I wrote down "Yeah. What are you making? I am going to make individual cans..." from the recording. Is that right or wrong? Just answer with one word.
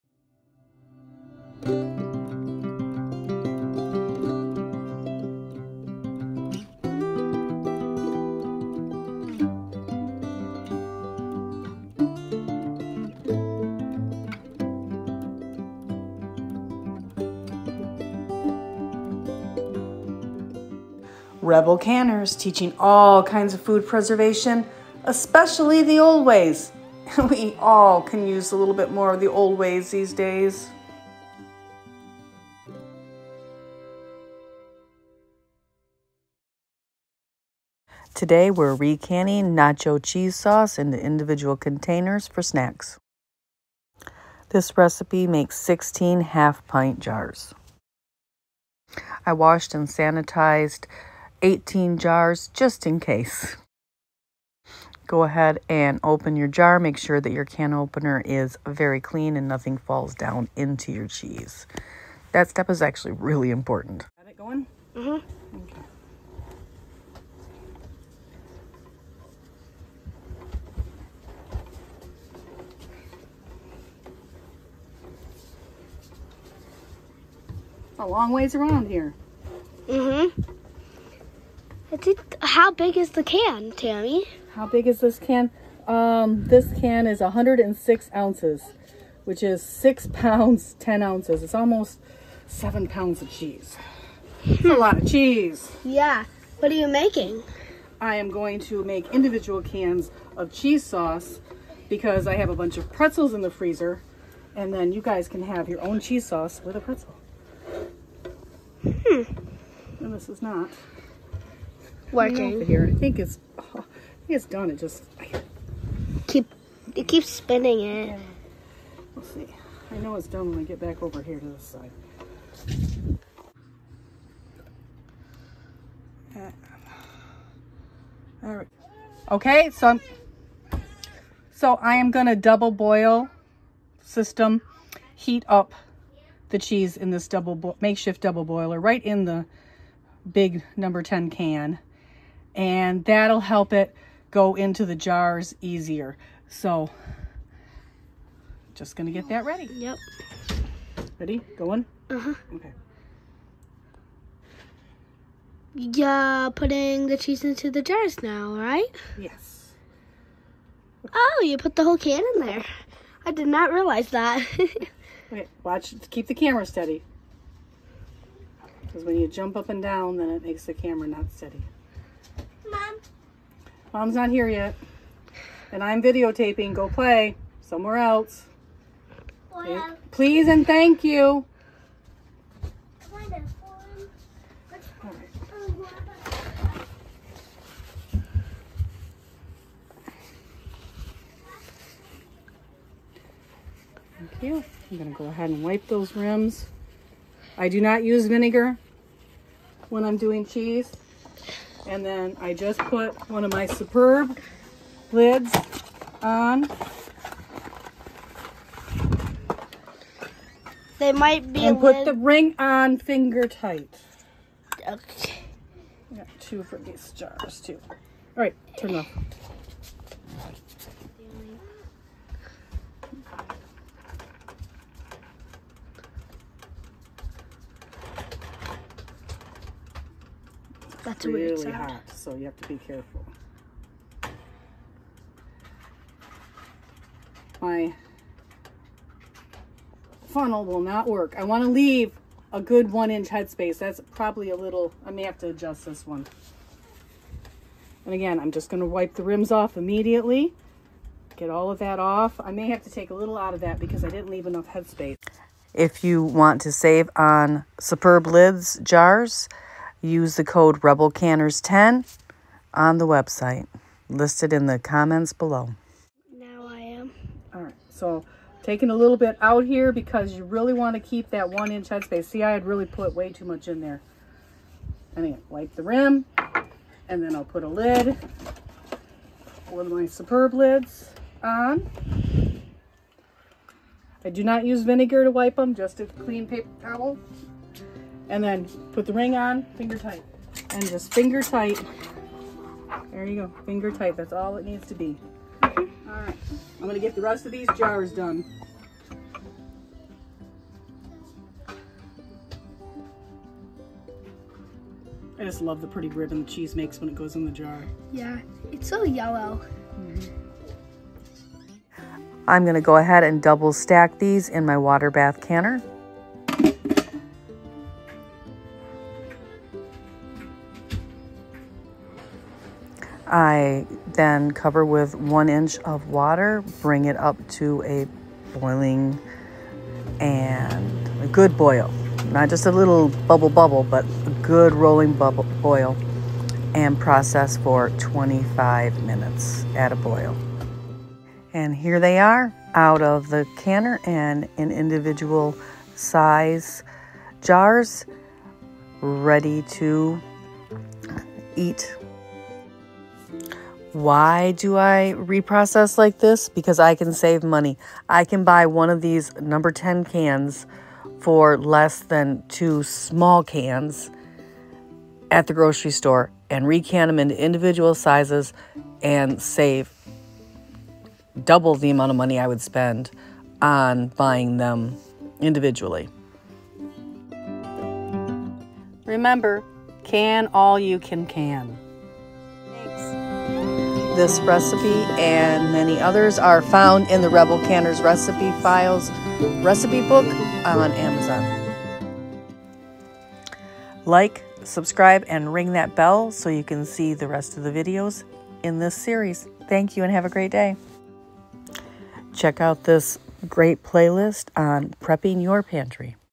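right.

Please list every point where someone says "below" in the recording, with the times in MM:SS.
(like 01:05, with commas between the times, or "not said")
04:25.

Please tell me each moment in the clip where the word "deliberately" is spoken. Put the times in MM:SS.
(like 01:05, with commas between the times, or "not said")
not said.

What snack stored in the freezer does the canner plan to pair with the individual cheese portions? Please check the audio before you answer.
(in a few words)
Pretzels.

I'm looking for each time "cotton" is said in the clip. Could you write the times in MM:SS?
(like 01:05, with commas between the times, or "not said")
not said.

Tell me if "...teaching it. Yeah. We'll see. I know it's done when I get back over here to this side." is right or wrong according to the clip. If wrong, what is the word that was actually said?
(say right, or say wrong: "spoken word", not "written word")
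wrong: "spinning", not "teaching".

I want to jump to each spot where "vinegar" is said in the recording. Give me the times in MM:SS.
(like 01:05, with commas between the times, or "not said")
03:18, 04:44.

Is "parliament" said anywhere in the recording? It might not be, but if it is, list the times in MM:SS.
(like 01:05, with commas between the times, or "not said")
not said.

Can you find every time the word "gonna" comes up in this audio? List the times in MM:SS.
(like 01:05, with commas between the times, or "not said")
02:12, 02:28, 03:14, 04:56.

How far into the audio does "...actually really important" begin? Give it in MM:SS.
01:02.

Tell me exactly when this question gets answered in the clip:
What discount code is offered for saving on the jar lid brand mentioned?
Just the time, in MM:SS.
04:20.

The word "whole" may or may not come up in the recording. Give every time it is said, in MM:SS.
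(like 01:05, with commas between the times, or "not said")
02:41.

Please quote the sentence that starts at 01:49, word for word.
And this is not working here.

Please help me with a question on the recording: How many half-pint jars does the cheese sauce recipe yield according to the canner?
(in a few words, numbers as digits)
16.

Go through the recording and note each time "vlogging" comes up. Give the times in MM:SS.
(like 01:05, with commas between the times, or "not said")
not said.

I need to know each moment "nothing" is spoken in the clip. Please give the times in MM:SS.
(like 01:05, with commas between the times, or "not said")
00:59.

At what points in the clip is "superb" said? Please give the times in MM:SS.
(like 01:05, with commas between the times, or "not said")
03:23, 04:17, 04:40.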